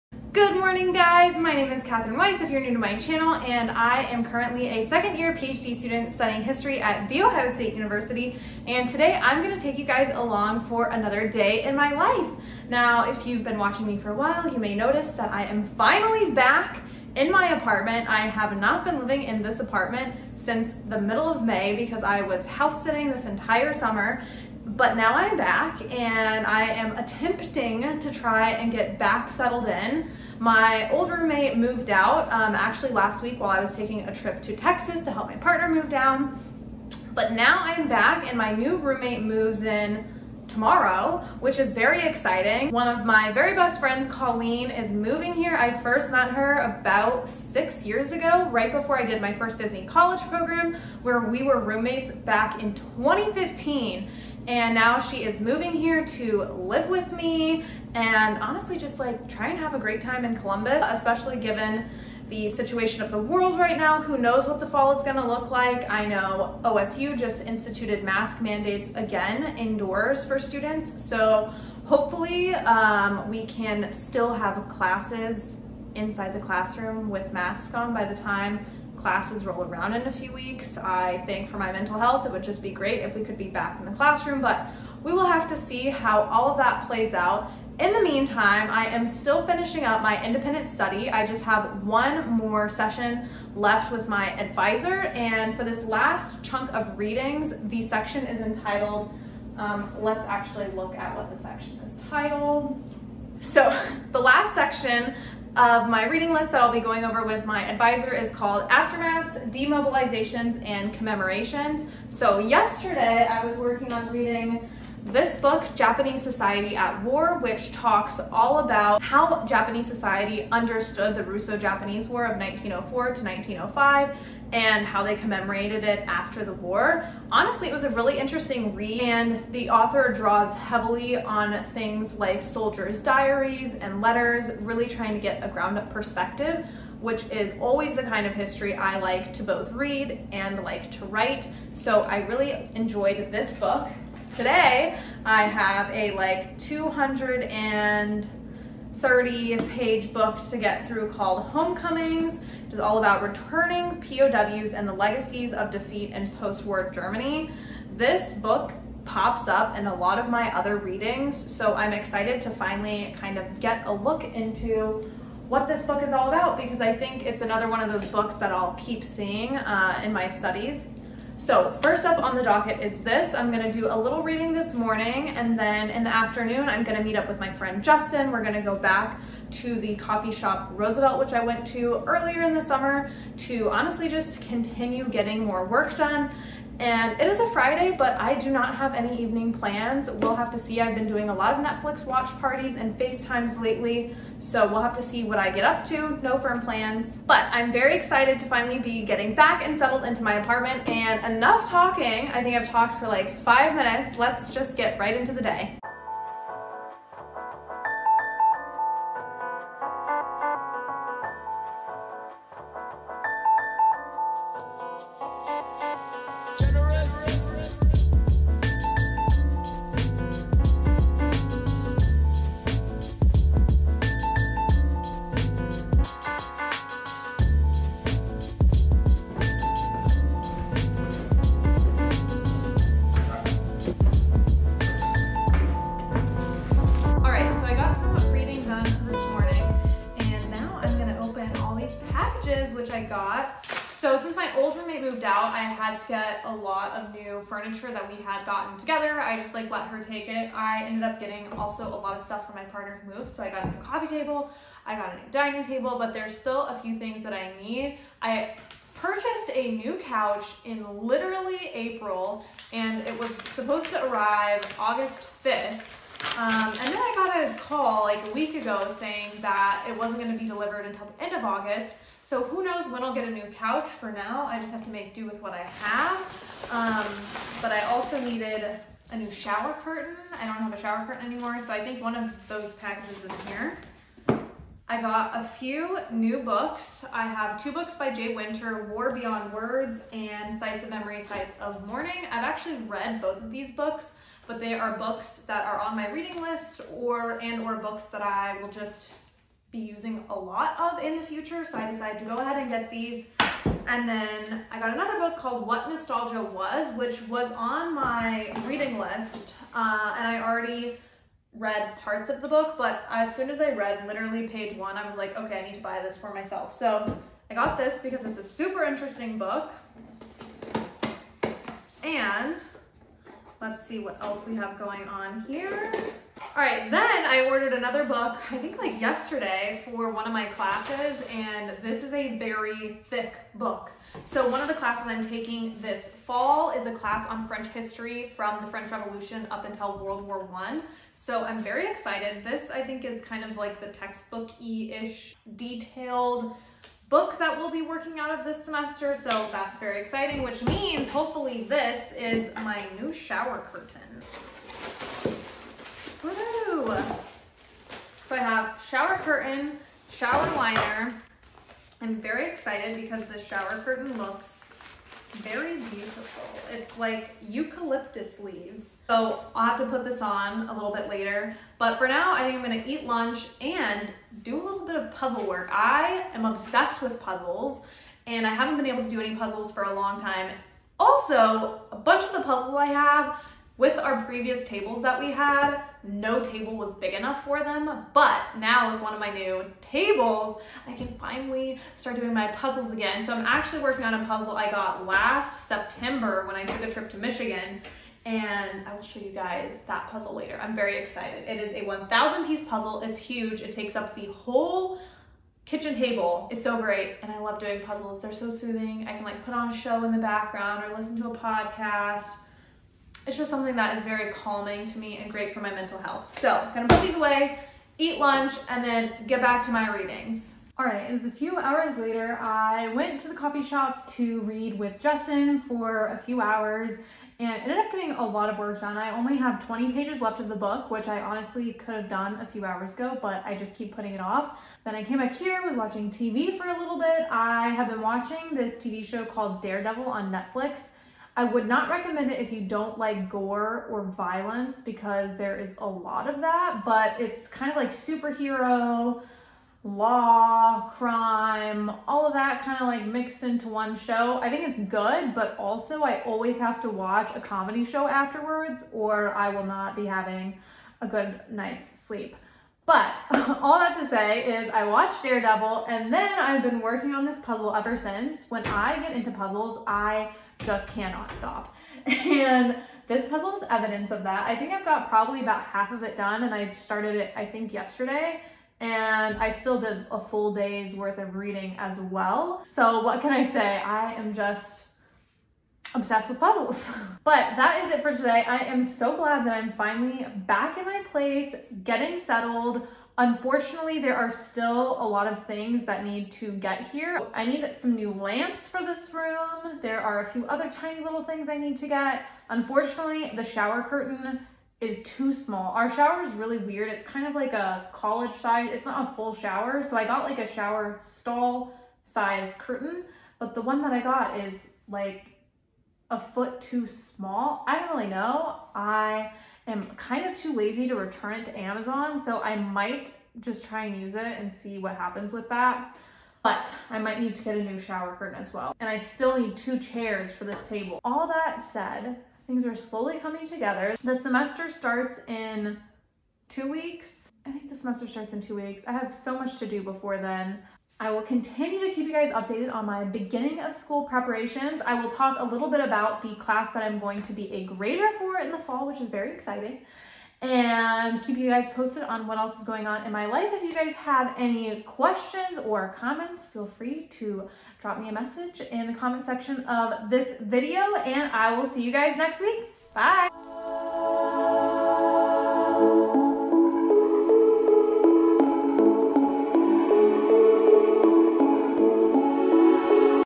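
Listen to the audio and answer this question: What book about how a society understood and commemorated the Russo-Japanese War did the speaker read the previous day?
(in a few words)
Japanese Society at War.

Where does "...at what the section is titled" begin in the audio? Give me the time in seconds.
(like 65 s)
100 s.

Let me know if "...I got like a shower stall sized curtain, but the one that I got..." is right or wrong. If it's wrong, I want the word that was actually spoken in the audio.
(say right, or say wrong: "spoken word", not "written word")
right.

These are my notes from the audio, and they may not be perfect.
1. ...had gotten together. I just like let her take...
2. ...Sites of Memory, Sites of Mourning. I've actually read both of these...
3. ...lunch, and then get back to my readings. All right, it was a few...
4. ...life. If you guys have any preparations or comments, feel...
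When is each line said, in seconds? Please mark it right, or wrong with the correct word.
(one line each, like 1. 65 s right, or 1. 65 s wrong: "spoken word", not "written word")
1. 248 s right
2. 290 s right
3. 418 s right
4. 553 s wrong: "questions", not "preparations".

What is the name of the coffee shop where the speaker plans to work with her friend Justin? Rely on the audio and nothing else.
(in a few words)
Roosevelt.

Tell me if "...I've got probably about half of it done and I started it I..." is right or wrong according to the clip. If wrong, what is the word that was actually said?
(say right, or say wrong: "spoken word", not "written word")
right.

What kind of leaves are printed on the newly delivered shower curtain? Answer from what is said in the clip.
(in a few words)
Eucalyptus.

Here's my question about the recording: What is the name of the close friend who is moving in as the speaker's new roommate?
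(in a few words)
Colleen.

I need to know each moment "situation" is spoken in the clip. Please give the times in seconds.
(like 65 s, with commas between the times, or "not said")
62 s.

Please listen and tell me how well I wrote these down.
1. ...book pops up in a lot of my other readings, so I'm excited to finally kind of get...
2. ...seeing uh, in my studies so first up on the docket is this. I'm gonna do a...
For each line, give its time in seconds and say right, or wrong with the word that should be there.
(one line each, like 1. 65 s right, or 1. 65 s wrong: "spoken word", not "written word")
1. 158 s right
2. 169 s right.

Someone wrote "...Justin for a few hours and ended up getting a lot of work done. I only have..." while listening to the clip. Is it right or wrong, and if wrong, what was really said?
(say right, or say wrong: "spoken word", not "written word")
right.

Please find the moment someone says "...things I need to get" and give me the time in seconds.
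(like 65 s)
501 s.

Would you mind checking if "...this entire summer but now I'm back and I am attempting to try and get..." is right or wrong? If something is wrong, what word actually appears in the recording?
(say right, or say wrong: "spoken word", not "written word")
right.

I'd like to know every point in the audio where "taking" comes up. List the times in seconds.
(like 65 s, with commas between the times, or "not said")
33 s, 335 s.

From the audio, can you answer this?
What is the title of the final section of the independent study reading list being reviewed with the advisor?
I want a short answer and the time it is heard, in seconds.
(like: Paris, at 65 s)
Aftermaths, Demobilizations, and Commemorations, at 108 s.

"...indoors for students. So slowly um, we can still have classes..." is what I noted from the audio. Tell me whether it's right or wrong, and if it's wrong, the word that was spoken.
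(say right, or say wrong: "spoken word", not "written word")
wrong: "hopefully", not "slowly".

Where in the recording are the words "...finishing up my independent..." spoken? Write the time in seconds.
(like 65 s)
89 s.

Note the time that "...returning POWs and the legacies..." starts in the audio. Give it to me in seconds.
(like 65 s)
153 s.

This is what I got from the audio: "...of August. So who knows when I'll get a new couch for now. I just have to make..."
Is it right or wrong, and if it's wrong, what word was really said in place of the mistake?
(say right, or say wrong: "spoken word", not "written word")
right.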